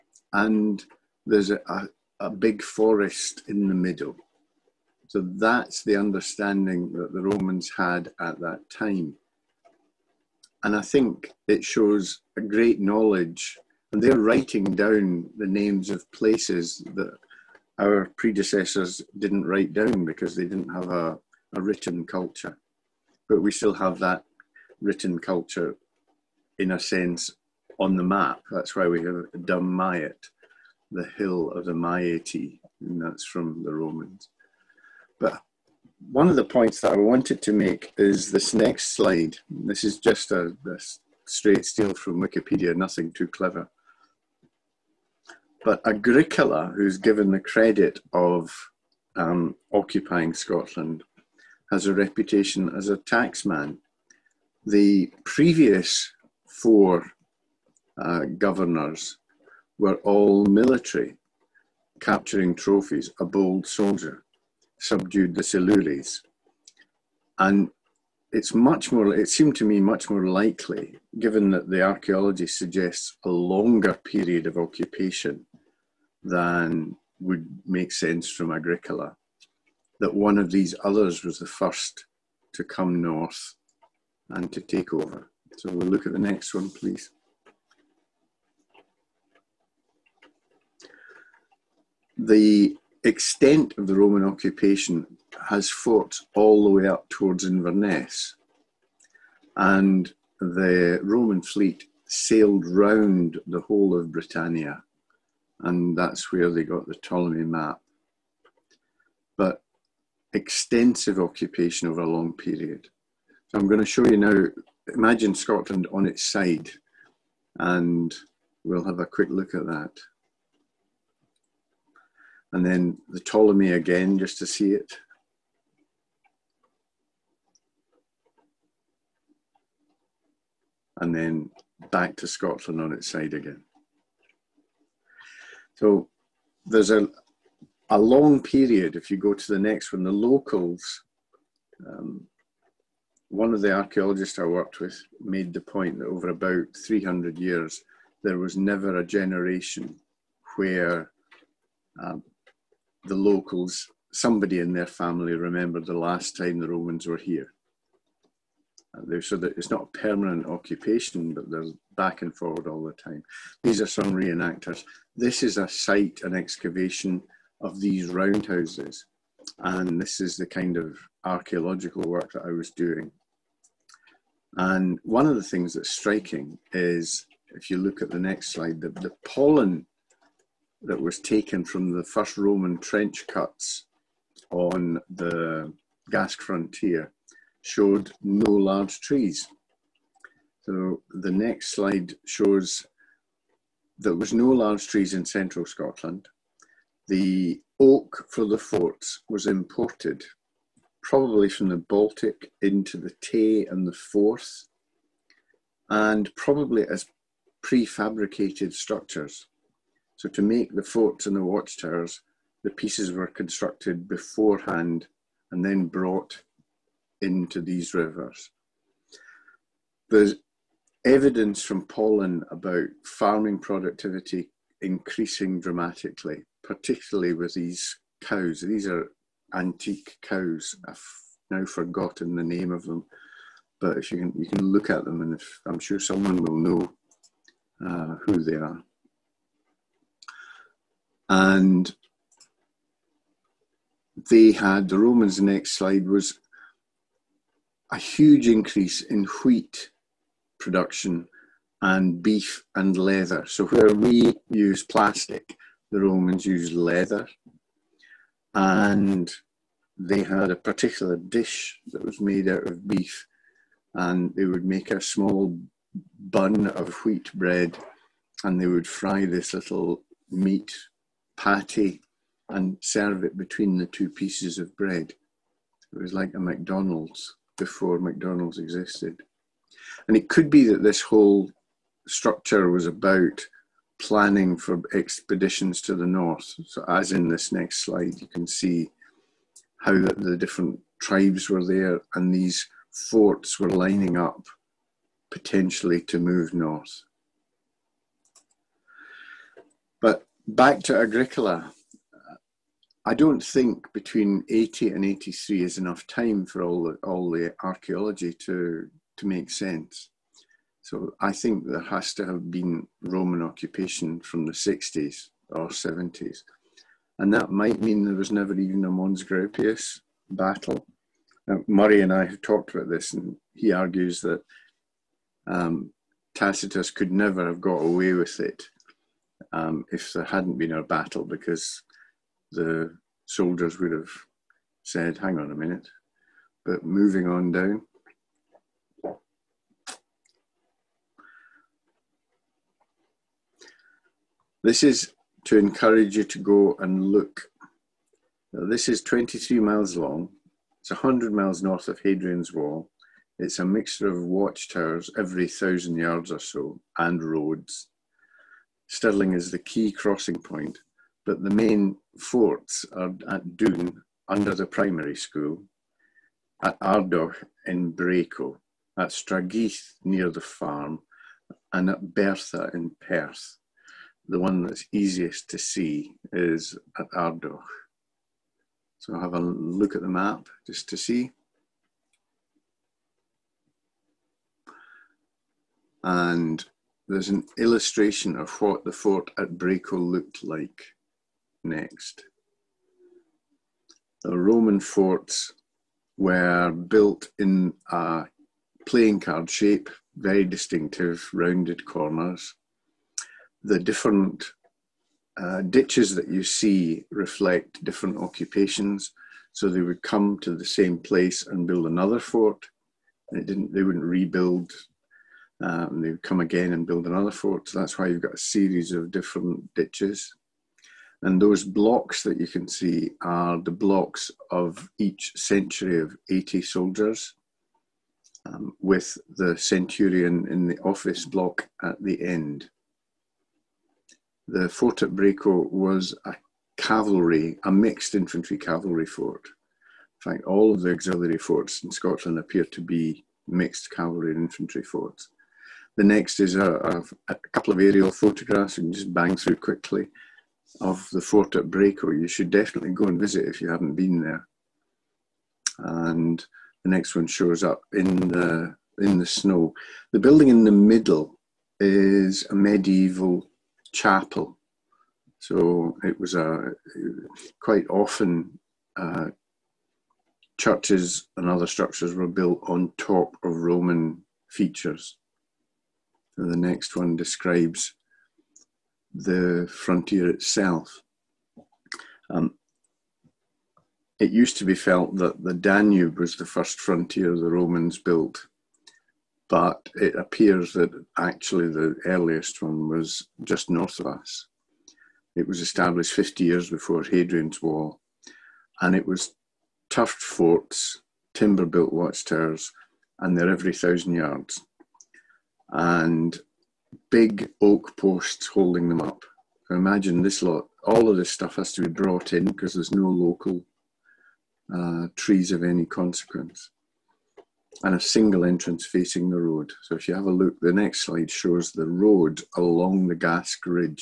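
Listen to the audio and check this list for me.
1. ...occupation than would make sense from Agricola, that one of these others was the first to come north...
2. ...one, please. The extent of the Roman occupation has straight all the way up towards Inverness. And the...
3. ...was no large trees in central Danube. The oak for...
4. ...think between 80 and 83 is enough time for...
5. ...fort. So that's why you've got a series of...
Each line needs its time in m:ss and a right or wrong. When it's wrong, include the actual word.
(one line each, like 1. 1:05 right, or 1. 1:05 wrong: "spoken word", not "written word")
1. 1:14 right
2. 1:26 wrong: "fought", not "straight"
3. 3:14 wrong: "Scotland", not "Danube"
4. 5:03 right
5. 6:57 right.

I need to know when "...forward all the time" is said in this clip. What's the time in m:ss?
2:42.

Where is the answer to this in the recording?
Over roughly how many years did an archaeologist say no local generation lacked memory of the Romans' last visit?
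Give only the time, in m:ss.
2:26.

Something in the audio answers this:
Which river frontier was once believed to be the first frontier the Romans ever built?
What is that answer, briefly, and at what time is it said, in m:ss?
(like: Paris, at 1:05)
The Danube, at 8:05.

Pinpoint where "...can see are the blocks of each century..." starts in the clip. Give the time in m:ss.
7:02.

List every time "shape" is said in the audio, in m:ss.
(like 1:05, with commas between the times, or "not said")
6:39.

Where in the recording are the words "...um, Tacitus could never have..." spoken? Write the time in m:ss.
5:25.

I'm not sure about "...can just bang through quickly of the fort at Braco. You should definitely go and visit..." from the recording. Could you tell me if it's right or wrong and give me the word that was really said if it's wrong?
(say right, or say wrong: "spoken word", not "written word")
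right.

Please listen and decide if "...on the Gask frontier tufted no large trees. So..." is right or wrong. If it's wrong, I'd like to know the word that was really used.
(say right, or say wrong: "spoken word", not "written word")
wrong: "showed", not "tufted".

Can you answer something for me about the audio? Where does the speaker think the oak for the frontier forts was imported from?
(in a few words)
The Baltic.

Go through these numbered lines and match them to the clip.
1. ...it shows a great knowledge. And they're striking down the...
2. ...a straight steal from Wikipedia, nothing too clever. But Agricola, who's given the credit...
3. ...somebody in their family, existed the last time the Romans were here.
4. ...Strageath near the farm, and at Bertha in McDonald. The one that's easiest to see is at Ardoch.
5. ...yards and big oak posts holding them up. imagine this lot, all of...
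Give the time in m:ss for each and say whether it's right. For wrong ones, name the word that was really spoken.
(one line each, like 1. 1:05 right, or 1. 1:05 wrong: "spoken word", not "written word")
1. 0:11 wrong: "writing", not "striking"
2. 0:40 right
3. 2:34 wrong: "remembered", not "existed"
4. 6:09 wrong: "Perth", not "McDonald"
5. 8:24 right.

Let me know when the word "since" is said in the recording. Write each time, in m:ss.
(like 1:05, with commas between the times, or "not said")
not said.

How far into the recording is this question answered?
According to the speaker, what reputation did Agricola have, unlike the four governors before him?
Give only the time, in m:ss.
0:52.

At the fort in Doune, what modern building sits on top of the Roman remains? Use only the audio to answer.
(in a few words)
The primary school.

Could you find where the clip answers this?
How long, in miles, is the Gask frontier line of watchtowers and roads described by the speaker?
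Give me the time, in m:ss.
5:49.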